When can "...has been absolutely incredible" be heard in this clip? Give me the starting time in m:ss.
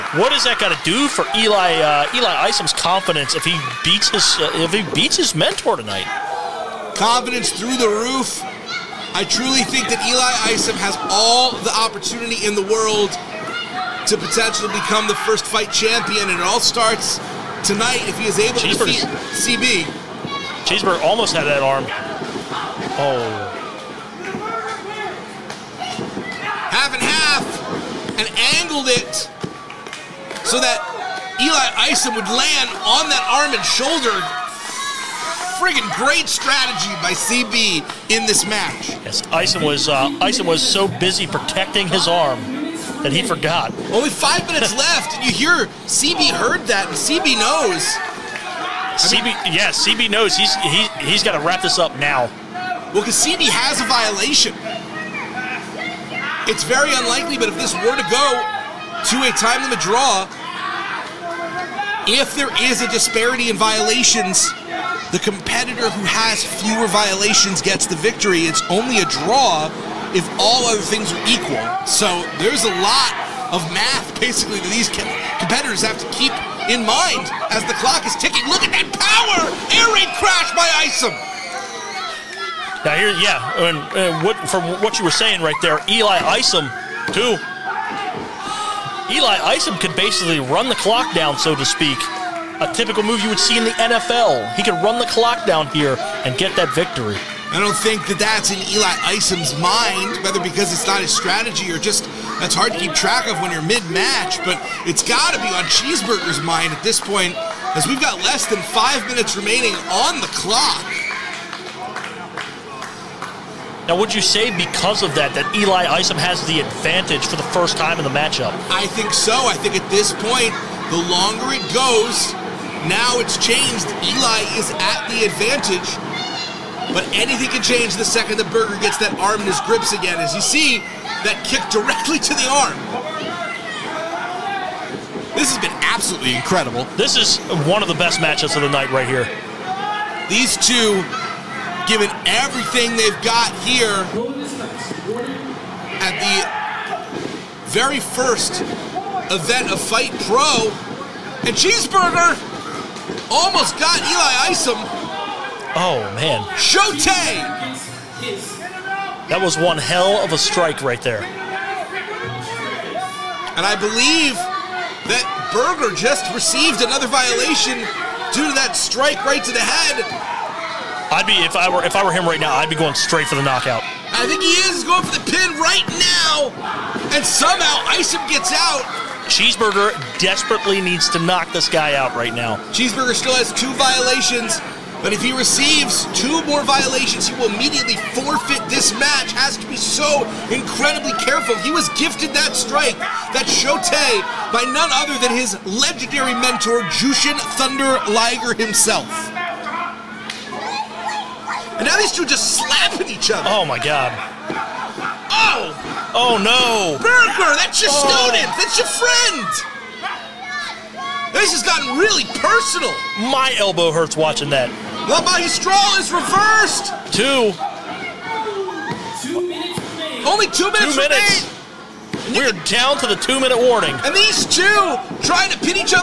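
2:15.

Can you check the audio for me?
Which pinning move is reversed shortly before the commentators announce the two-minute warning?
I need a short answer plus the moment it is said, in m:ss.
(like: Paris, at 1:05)
Magistral, at 3:35.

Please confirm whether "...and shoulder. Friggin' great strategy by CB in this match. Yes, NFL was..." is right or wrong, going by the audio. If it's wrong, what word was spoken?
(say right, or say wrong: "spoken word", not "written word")
wrong: "Isom", not "NFL".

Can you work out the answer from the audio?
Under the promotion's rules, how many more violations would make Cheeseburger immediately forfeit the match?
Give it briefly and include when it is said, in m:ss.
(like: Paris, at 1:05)
2, at 3:05.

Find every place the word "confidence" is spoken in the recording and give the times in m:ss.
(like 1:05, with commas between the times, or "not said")
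0:02, 0:06.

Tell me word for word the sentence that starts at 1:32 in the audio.
A typical move you would see in the NFL.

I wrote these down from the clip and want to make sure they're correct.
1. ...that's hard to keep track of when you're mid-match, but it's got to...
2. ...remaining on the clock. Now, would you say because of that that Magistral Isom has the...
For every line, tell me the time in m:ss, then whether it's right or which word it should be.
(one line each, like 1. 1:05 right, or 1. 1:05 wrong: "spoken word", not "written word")
1. 1:42 right
2. 1:49 wrong: "Eli", not "Magistral".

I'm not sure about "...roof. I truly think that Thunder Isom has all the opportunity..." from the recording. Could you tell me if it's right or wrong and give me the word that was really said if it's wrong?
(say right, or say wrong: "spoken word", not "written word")
wrong: "Eli", not "Thunder".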